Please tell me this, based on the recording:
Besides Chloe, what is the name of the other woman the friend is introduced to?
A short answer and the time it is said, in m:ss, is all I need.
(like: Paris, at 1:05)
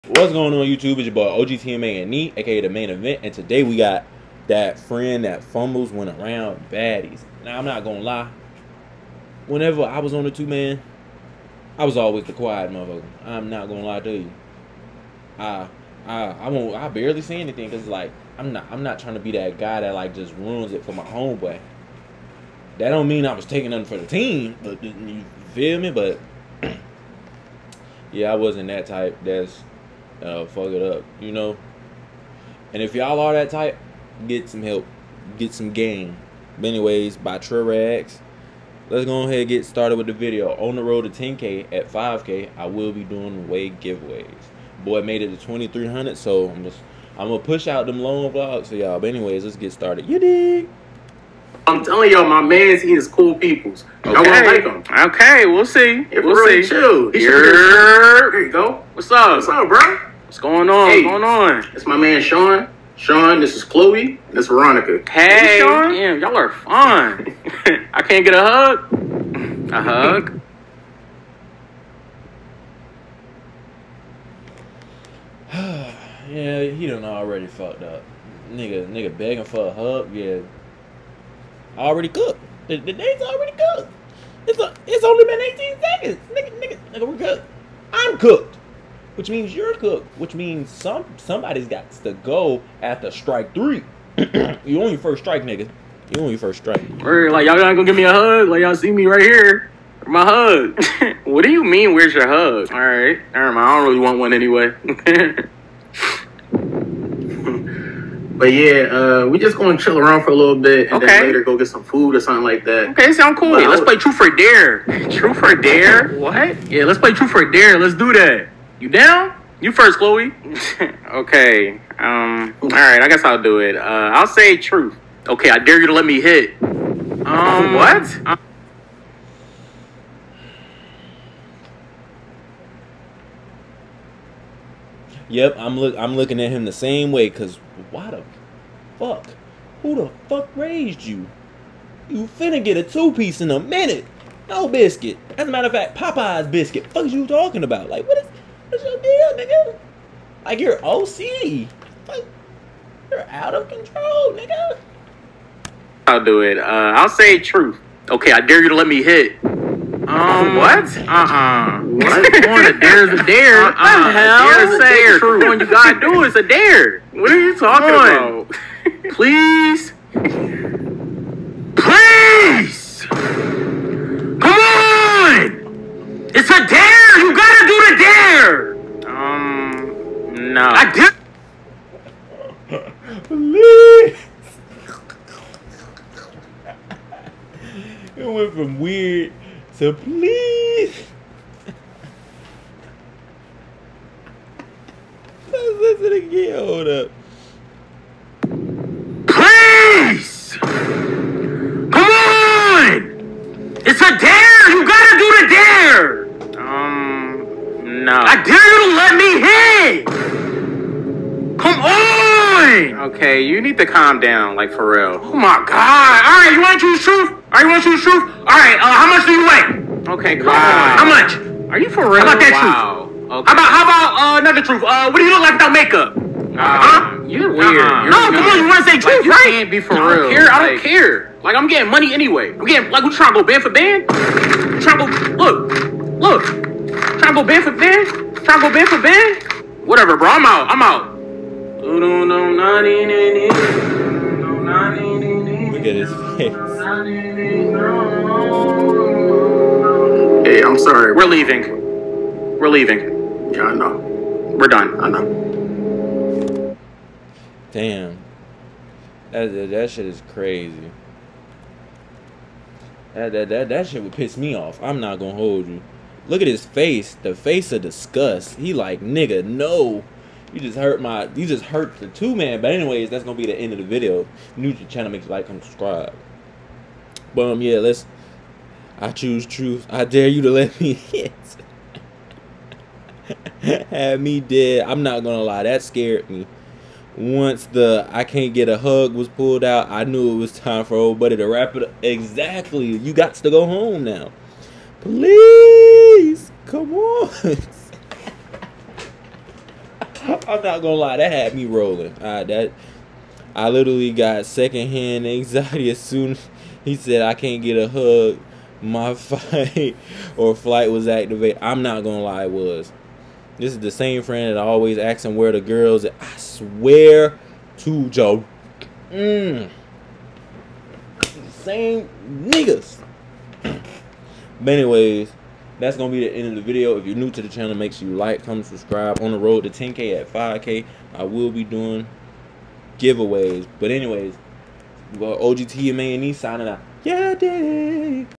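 Veronica, at 1:04.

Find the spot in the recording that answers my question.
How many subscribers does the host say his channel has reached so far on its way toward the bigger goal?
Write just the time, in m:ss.
0:45.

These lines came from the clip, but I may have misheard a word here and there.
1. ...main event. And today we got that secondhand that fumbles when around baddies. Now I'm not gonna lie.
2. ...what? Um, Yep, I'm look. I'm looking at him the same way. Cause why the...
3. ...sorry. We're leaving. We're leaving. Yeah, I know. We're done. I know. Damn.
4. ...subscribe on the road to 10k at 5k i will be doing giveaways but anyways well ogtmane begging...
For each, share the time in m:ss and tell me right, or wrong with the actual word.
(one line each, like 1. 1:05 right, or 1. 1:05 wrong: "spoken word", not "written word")
1. 0:02 wrong: "friend", not "secondhand"
2. 2:07 right
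3. 4:10 right
4. 5:28 wrong: "signing", not "begging".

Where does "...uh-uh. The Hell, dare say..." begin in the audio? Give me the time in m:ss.
2:43.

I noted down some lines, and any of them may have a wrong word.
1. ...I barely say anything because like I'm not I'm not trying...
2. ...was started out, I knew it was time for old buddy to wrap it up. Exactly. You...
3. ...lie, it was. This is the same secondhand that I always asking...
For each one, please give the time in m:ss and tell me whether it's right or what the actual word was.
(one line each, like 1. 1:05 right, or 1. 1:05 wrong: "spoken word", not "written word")
1. 0:16 right
2. 4:49 wrong: "pulled", not "started"
3. 5:12 wrong: "friend", not "secondhand".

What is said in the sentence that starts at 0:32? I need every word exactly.
And if y'all are that type, get some help, get some game.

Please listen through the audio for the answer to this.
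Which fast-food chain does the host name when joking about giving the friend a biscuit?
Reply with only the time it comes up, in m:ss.
2:25.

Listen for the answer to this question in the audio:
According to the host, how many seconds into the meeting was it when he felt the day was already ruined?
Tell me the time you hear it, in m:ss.
1:26.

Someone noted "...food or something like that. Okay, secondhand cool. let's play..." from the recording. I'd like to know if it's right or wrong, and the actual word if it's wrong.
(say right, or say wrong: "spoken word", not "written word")
wrong: "sound", not "secondhand".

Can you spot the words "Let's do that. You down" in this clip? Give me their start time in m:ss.
1:57.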